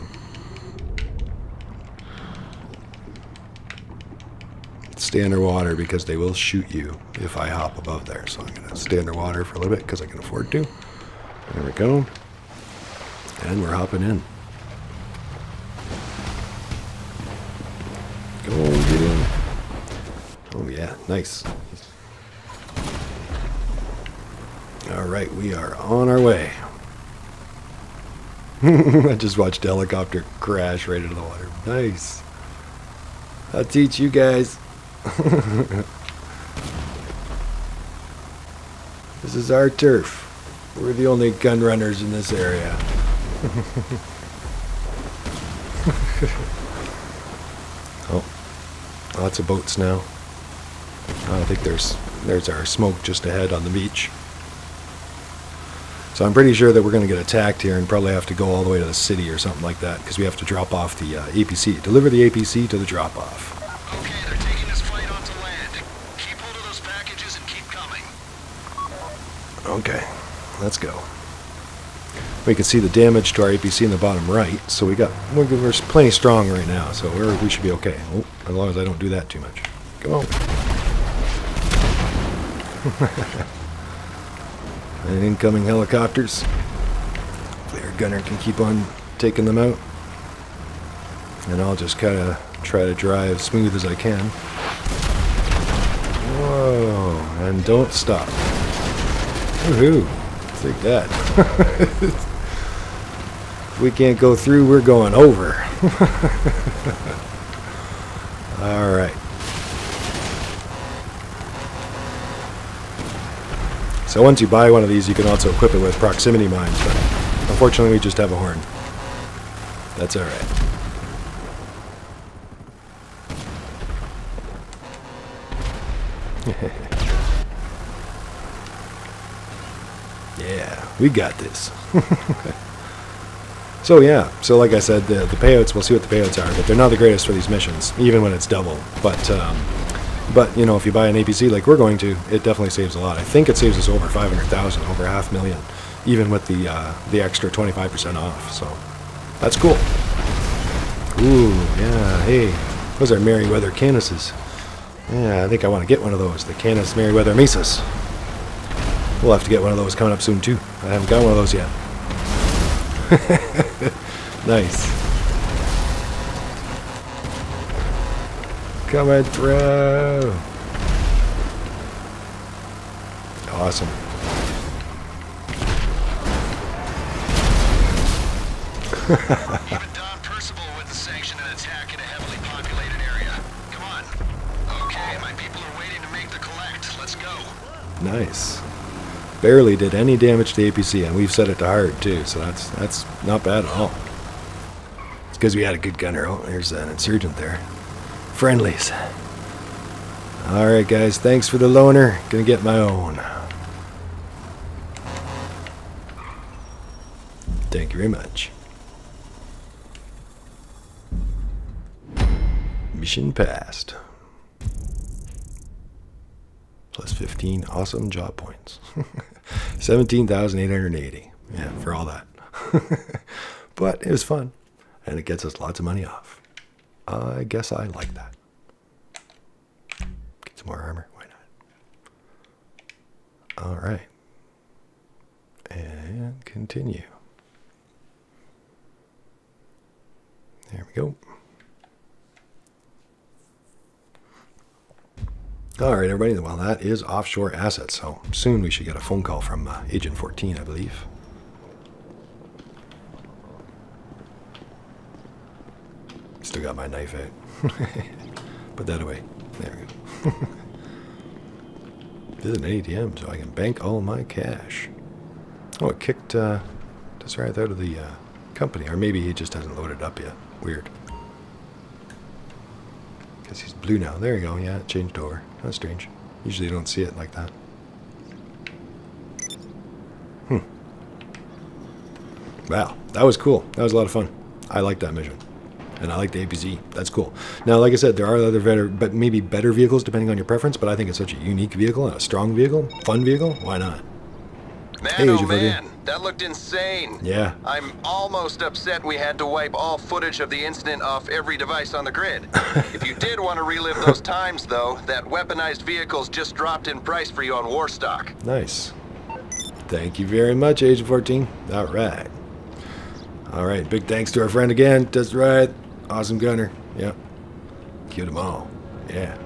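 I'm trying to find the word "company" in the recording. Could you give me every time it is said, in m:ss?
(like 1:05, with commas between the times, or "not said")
4:28.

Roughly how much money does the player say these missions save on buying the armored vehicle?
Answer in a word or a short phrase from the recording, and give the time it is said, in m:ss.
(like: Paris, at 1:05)
Over 500,000, at 2:23.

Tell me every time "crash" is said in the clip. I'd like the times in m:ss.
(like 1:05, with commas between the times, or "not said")
0:30.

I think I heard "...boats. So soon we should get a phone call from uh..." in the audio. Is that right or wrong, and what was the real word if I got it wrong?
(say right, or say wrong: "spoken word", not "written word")
wrong: "assets", not "boats".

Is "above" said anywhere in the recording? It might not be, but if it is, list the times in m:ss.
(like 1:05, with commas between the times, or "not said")
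0:07.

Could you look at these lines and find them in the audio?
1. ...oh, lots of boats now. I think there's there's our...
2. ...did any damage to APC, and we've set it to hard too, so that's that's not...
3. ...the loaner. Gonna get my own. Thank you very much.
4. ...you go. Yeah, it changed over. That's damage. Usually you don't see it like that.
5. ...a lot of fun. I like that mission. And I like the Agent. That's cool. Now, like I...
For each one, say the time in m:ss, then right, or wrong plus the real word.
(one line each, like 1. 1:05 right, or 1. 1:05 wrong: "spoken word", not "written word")
1. 0:48 right
2. 3:09 right
3. 3:21 right
4. 4:34 wrong: "strange", not "damage"
5. 4:43 wrong: "APC", not "Agent".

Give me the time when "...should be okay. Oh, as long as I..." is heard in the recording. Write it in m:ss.
1:17.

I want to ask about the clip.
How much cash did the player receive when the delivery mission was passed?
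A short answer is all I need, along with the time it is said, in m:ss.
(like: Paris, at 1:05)
17,880, at 3:39.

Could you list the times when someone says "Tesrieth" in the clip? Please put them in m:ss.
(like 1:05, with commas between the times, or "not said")
4:27, 5:15.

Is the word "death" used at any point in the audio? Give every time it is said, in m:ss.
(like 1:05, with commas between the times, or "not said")
not said.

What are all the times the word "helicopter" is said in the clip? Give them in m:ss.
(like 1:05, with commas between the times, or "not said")
0:29, 1:25.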